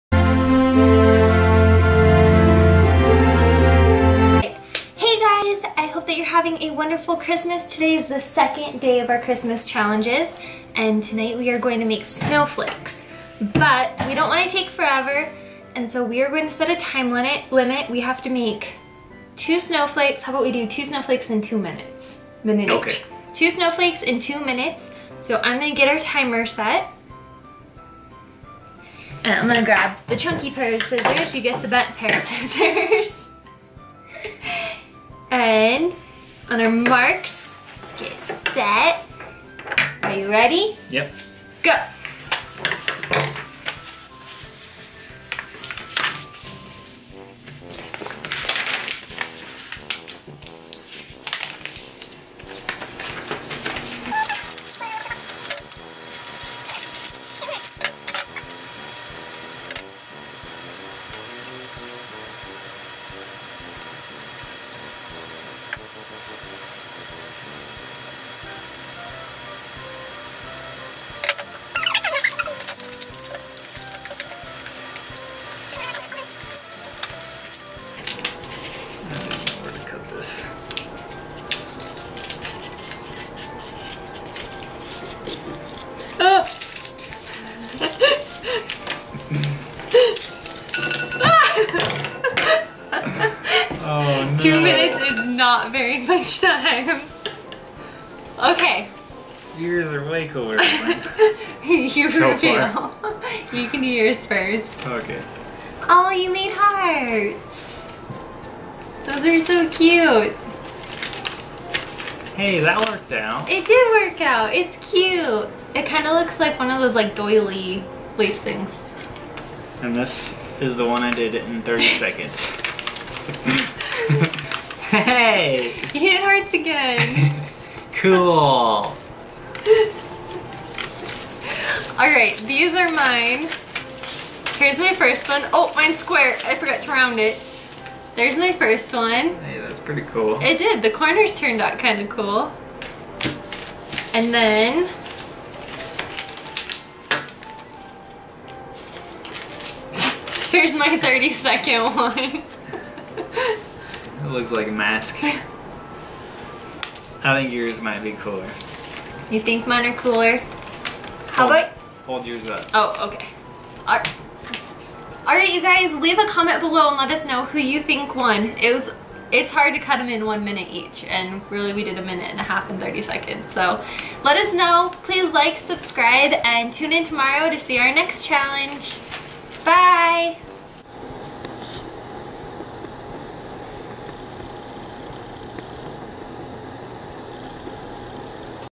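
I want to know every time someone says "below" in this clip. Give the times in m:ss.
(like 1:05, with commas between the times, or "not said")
2:46.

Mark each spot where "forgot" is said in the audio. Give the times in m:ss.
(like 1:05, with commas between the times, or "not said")
2:16.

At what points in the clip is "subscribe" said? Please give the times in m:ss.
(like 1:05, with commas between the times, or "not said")
2:55.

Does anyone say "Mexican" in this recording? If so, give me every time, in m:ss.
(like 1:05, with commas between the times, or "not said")
not said.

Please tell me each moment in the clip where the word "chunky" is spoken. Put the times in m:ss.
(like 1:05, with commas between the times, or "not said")
0:30.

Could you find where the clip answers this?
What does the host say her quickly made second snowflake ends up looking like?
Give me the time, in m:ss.
2:34.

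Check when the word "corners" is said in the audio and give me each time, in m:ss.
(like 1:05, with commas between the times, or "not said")
2:20.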